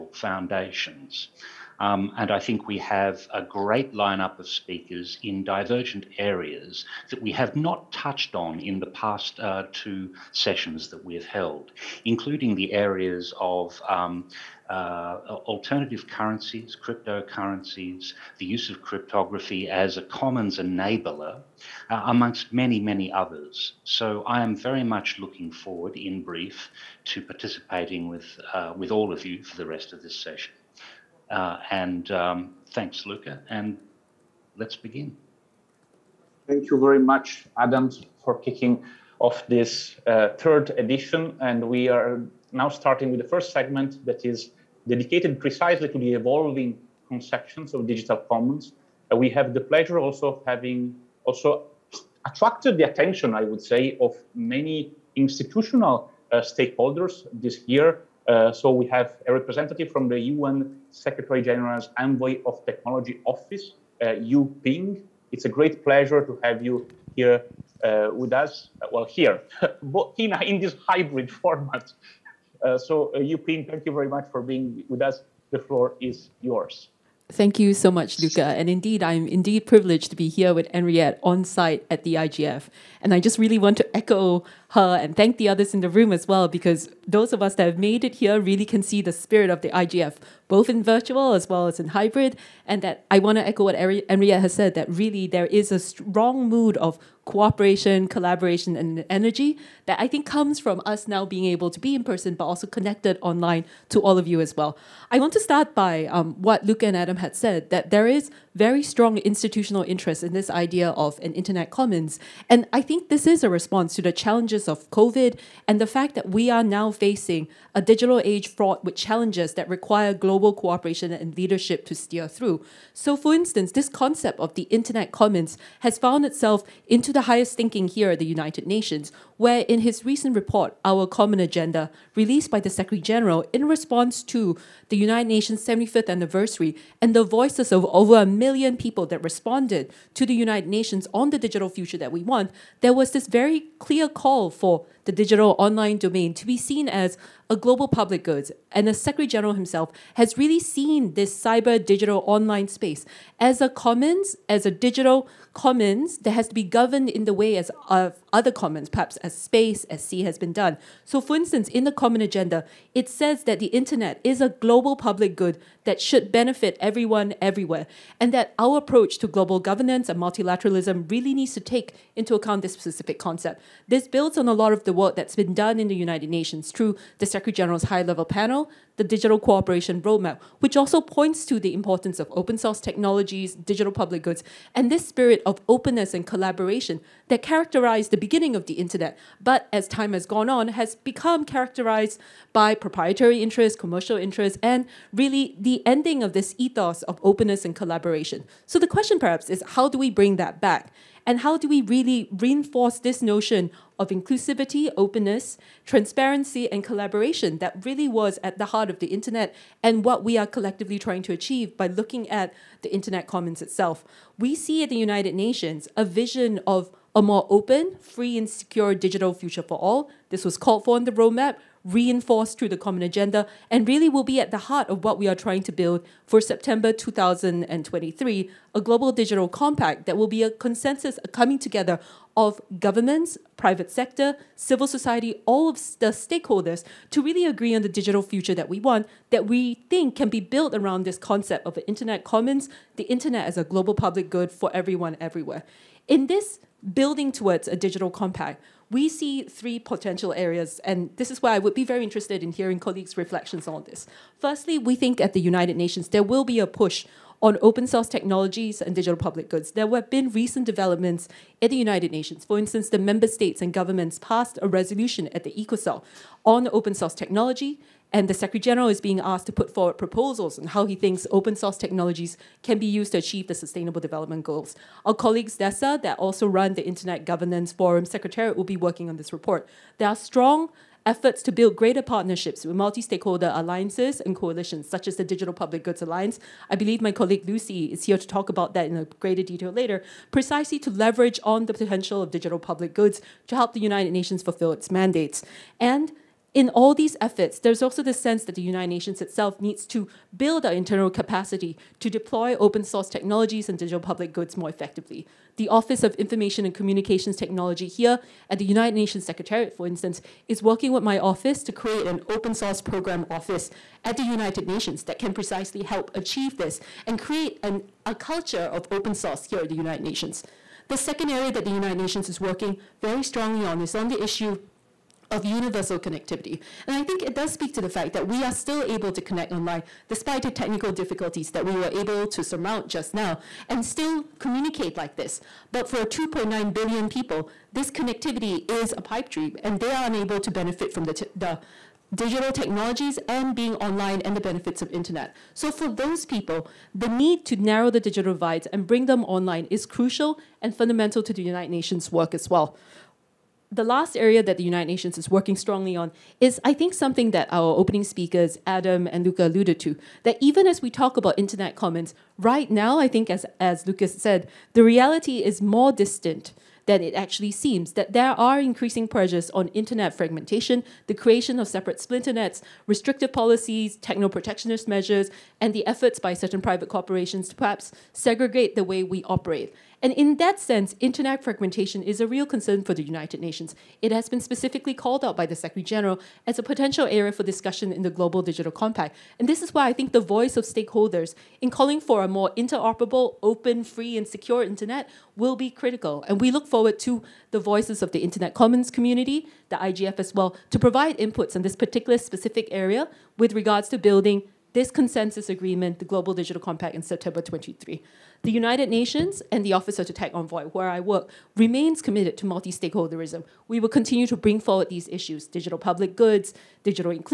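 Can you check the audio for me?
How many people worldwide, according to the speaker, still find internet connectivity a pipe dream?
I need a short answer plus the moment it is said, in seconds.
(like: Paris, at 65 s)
2.9 billion, at 336 s.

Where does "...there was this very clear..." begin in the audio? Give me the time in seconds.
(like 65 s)
142 s.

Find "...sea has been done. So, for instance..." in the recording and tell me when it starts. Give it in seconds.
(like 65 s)
160 s.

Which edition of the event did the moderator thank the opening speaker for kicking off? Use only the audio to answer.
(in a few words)
third.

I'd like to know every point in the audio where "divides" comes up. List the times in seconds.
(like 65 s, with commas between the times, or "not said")
348 s.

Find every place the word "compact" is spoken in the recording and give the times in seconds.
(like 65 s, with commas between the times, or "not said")
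229 s, 248 s, 388 s, 406 s.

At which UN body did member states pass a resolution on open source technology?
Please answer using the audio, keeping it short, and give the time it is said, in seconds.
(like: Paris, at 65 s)
ECOSOC, at 265 s.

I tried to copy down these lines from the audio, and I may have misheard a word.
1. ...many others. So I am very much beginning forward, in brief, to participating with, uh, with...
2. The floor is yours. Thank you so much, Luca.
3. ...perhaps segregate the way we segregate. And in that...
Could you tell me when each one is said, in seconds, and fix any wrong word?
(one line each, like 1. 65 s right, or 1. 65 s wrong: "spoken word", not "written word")
1. 22 s wrong: "looking", not "beginning"
2. 75 s right
3. 377 s wrong: "operate", not "segregate".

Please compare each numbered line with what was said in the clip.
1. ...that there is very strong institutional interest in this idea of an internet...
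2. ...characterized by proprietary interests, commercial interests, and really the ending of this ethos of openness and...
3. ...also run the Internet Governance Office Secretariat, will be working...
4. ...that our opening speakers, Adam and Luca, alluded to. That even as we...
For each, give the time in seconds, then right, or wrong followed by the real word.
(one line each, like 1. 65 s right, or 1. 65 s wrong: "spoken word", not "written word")
1. 107 s right
2. 191 s right
3. 276 s wrong: "Forum", not "Office"
4. 357 s right.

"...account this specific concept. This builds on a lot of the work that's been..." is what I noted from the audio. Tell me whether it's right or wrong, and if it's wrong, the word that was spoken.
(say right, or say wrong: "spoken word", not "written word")
right.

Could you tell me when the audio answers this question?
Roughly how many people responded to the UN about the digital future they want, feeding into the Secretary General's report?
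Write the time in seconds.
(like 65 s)
137 s.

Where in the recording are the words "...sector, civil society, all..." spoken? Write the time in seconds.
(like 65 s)
233 s.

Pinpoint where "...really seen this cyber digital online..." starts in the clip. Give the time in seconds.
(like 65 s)
150 s.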